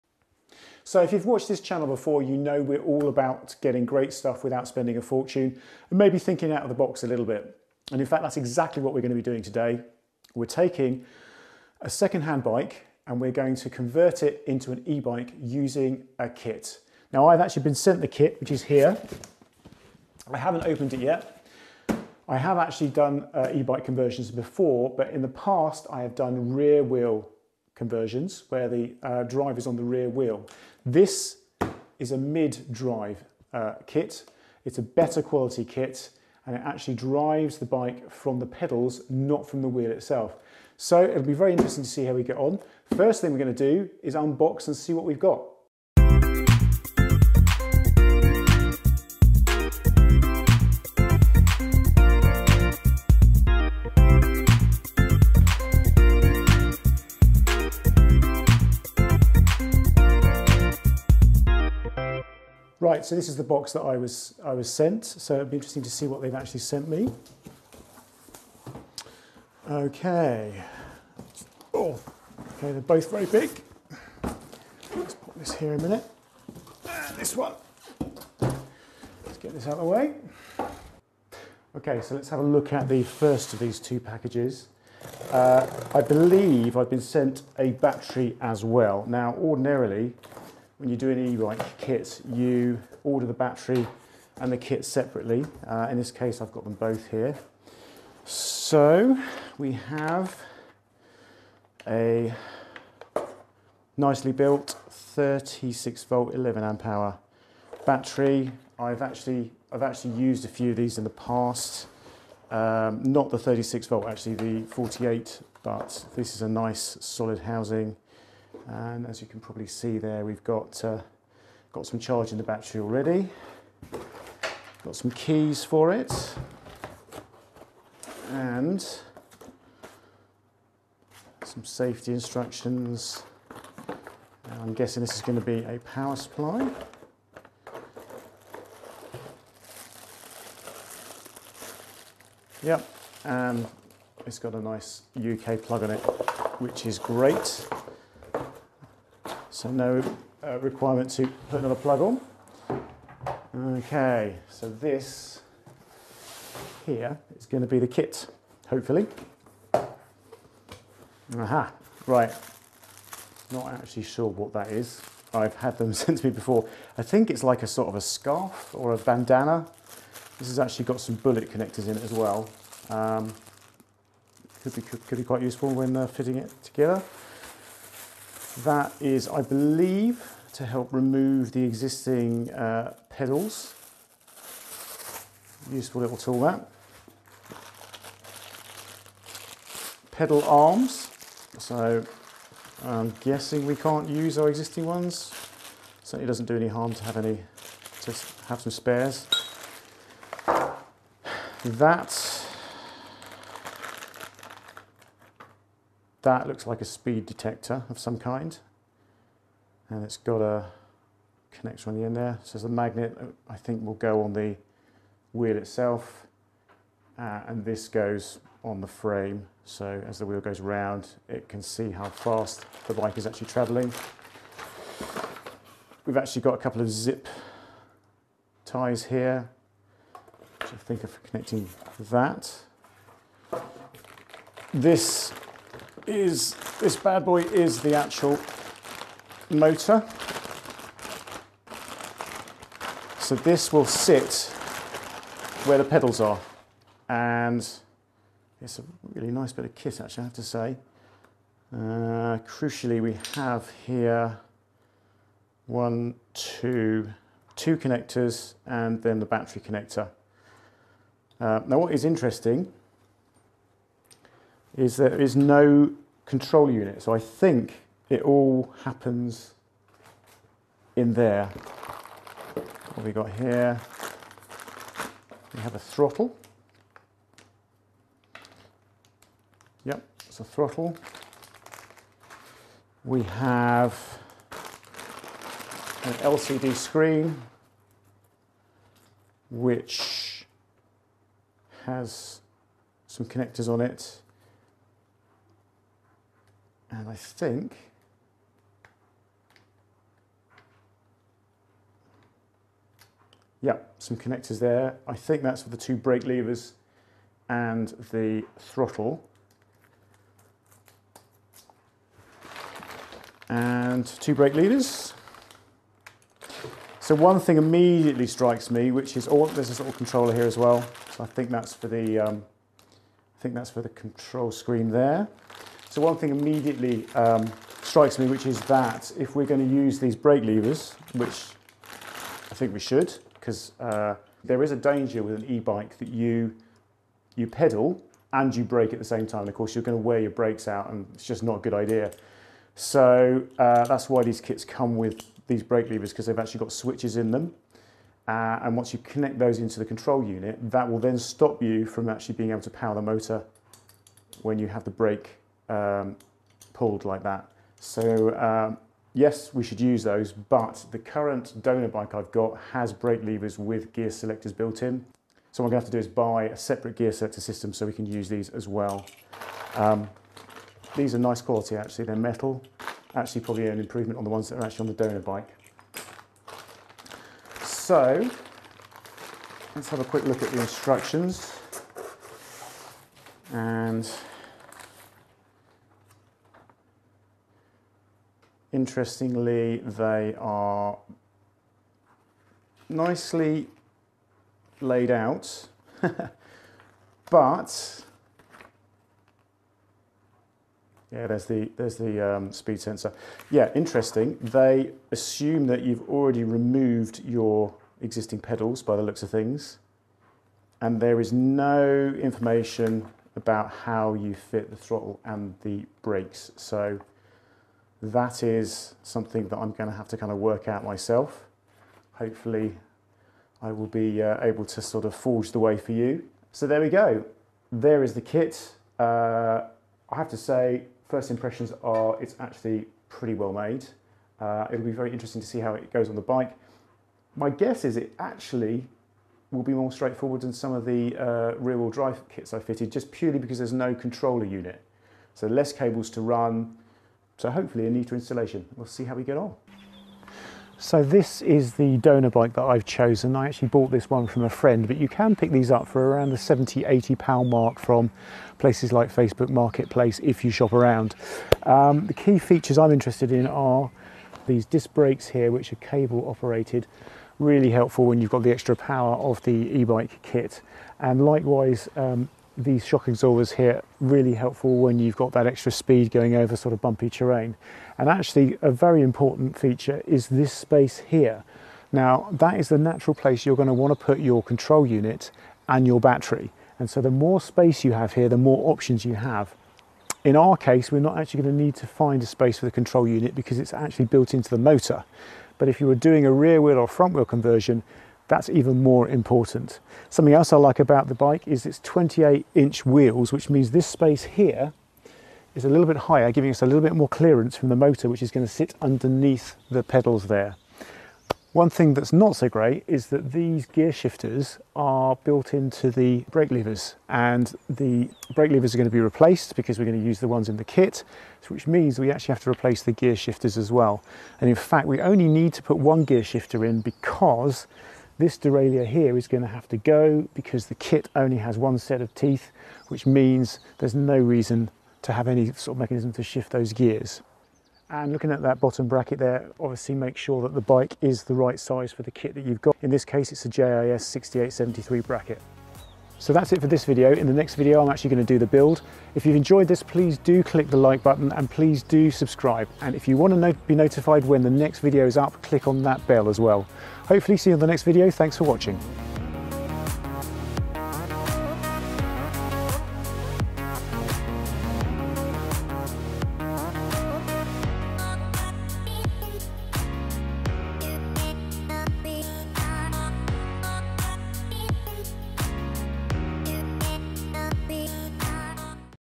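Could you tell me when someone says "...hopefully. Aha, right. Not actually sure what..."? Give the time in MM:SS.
02:38.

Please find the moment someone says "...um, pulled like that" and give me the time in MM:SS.
05:55.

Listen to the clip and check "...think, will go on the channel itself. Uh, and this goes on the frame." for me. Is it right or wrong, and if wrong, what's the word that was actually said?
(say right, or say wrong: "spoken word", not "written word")
wrong: "wheel", not "channel".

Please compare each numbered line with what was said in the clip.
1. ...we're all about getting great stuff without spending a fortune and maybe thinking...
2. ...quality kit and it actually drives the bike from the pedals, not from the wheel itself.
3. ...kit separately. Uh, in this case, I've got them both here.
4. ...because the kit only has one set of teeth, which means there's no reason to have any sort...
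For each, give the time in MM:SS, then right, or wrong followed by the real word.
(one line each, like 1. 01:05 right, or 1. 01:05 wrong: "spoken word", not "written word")
1. 00:02 right
2. 00:35 right
3. 01:34 right
4. 08:50 right.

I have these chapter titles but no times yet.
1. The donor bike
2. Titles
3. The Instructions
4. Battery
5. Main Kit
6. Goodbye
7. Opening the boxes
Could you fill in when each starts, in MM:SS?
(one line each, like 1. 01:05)
1. 07:30
2. 00:45
3. 06:16
4. 01:20
5. 02:36
6. 09:11
7. 01:02.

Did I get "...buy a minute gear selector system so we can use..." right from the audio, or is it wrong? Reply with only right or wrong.
wrong.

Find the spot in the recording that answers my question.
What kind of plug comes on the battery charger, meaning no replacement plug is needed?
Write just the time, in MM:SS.
02:25.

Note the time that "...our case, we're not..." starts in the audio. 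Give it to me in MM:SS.
08:10.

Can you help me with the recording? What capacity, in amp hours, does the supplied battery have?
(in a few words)
11 amp hour.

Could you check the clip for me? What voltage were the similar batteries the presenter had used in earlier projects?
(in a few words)
48.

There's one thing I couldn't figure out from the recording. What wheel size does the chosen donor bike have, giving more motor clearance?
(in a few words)
28 inch.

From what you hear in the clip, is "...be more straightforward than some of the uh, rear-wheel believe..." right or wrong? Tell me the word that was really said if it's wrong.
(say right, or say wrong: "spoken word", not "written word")
wrong: "drive", not "believe".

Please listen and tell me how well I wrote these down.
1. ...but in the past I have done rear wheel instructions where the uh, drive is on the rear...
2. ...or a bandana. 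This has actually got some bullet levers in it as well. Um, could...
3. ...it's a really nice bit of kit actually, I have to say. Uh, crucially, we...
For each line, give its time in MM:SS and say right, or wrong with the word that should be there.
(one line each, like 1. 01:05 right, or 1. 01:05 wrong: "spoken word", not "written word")
1. 00:24 wrong: "conversions", not "instructions"
2. 02:48 wrong: "connectors", not "levers"
3. 04:08 right.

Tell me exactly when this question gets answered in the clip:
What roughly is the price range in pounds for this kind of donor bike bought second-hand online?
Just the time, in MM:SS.
07:36.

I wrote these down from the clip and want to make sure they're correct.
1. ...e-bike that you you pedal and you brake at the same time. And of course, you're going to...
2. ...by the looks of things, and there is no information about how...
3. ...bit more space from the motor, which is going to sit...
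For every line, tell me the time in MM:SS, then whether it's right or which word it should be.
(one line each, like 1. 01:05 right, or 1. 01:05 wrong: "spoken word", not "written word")
1. 05:35 right
2. 06:48 right
3. 08:26 wrong: "clearance", not "space".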